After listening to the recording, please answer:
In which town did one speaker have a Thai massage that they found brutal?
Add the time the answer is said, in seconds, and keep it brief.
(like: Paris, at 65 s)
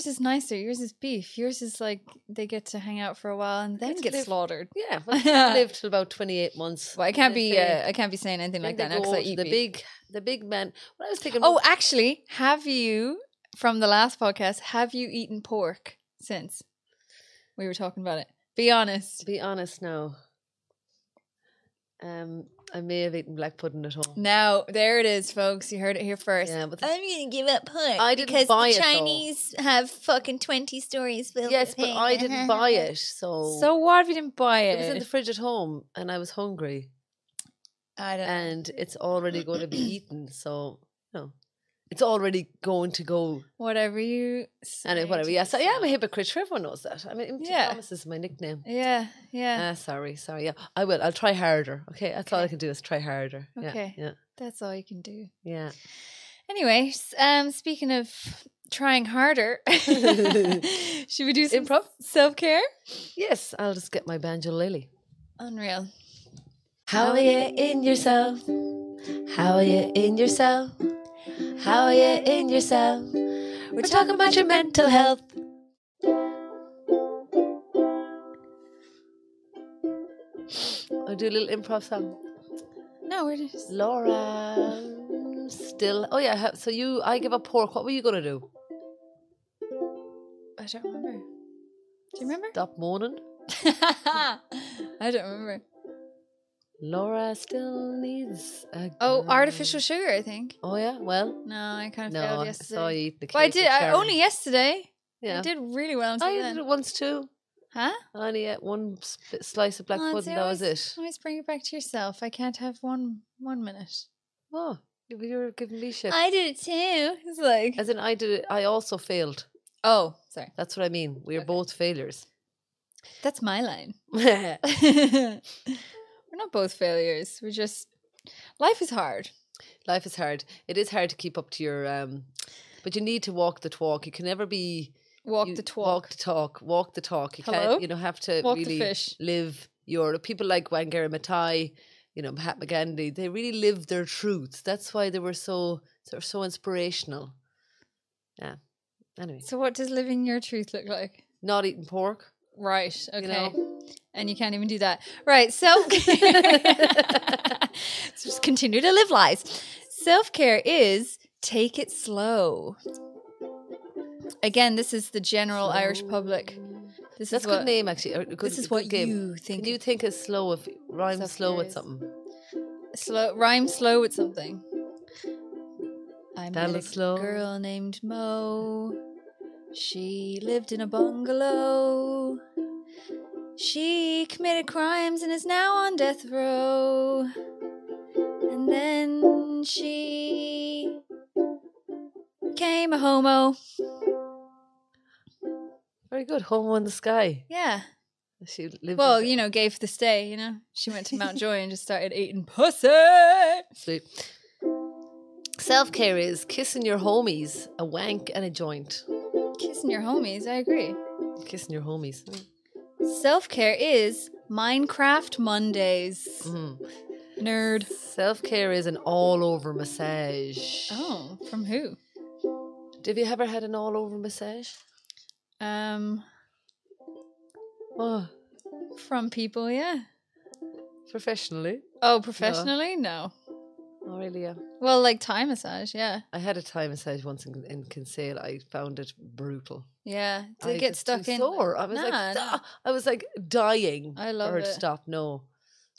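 Kinsale, at 237 s.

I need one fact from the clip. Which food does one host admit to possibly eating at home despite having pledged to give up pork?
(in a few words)
Black pudding.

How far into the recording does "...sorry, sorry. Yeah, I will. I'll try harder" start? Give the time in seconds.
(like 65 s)
49 s.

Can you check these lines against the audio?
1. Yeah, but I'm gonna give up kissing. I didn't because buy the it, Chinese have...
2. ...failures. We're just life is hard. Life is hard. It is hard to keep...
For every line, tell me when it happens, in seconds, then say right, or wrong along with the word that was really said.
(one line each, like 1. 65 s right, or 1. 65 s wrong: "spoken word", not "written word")
1. 26 s wrong: "pudding", not "kissing"
2. 126 s right.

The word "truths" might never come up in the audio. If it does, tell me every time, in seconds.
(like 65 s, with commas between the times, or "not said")
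144 s, 150 s.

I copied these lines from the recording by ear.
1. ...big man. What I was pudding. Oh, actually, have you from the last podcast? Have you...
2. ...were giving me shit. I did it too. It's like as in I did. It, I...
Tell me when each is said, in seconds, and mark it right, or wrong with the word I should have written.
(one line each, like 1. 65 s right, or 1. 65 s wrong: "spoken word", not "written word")
1. 10 s wrong: "thinking", not "pudding"
2. 115 s right.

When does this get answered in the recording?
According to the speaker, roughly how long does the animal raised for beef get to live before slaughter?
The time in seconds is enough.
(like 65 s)
6 s.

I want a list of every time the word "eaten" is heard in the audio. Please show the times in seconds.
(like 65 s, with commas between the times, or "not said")
15 s, 23 s, 39 s.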